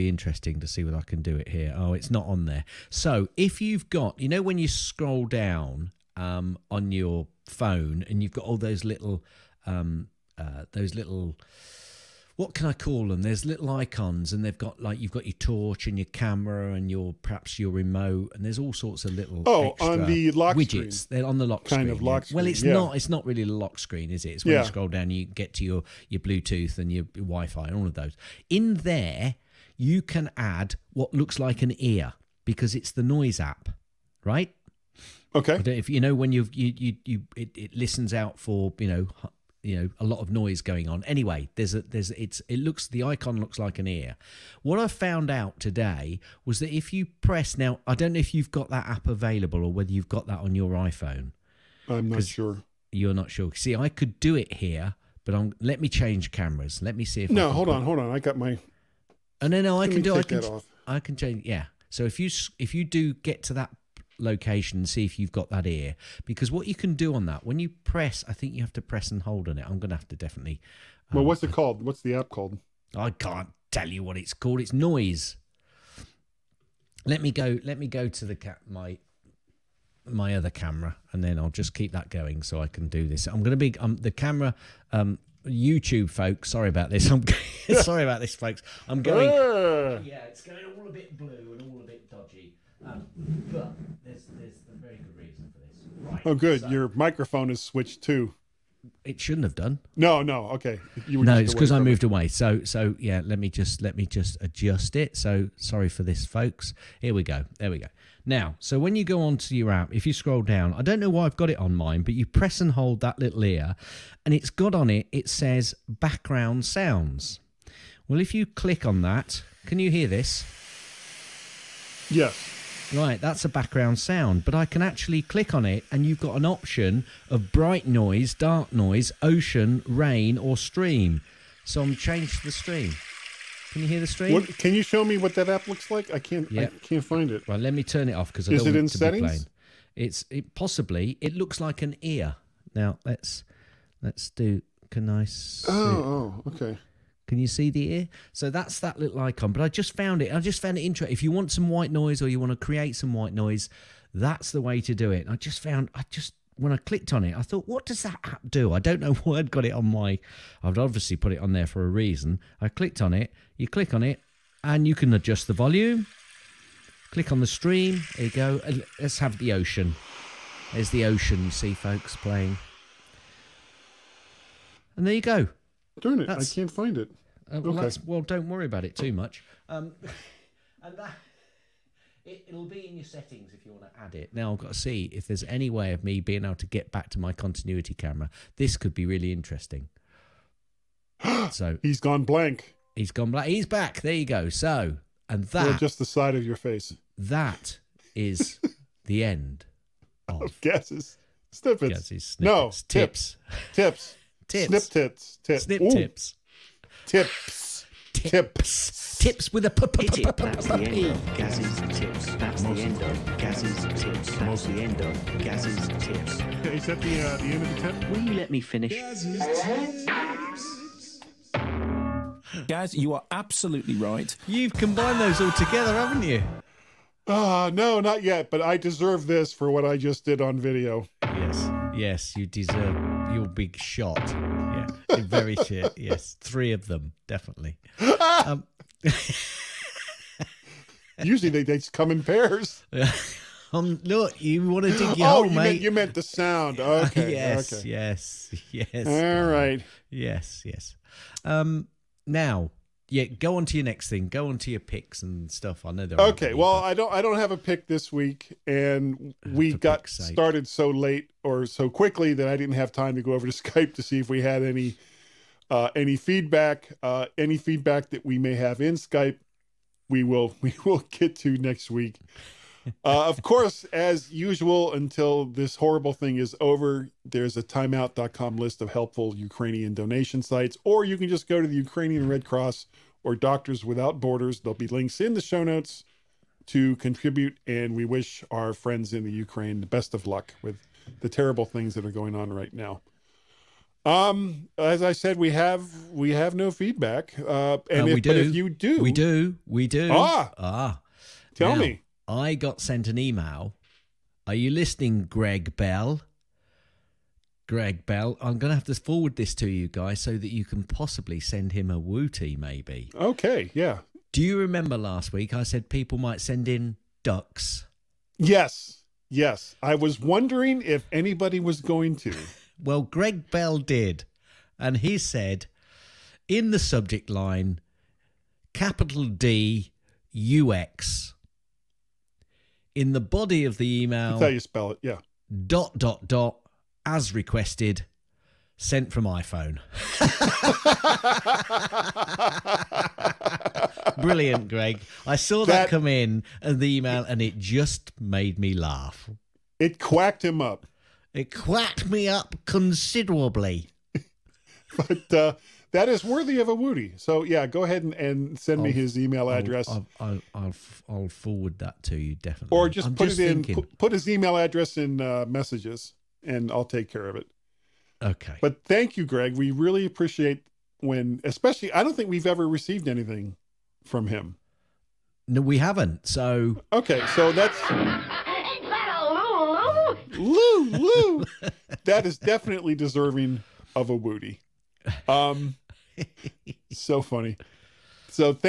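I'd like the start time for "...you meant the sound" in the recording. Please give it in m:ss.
4:05.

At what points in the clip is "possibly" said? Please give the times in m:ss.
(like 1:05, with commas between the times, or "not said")
2:20, 5:10.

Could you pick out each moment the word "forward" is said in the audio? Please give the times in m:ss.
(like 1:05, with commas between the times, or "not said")
5:08, 6:01.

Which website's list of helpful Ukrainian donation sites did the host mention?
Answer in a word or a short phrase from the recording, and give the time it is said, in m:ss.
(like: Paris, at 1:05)
timeout.com, at 4:37.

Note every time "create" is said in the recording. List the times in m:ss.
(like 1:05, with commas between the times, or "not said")
2:32.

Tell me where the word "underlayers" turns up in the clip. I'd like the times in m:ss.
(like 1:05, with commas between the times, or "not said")
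not said.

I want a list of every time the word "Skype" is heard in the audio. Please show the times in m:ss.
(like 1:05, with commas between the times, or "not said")
4:23, 4:28.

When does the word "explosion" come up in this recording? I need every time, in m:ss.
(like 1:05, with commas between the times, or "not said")
not said.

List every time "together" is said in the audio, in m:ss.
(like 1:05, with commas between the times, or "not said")
3:45.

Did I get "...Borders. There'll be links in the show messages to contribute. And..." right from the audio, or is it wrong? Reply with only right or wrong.
wrong.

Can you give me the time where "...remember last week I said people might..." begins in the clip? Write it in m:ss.
5:14.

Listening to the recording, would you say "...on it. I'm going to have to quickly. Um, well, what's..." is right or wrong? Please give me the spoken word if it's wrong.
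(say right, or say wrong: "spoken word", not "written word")
wrong: "definitely", not "quickly".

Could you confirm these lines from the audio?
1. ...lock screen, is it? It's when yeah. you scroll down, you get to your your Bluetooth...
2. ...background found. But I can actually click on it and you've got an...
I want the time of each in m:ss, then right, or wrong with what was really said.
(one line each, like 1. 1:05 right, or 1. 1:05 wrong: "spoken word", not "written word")
1. 0:23 right
2. 2:03 wrong: "sound", not "found".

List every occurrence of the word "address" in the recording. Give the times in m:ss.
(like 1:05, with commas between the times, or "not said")
5:59, 6:04.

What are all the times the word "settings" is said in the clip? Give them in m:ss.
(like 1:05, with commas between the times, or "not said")
2:18, 3:03.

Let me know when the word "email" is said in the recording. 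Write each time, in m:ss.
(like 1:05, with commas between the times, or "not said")
5:03, 5:34, 5:46, 5:59, 6:04.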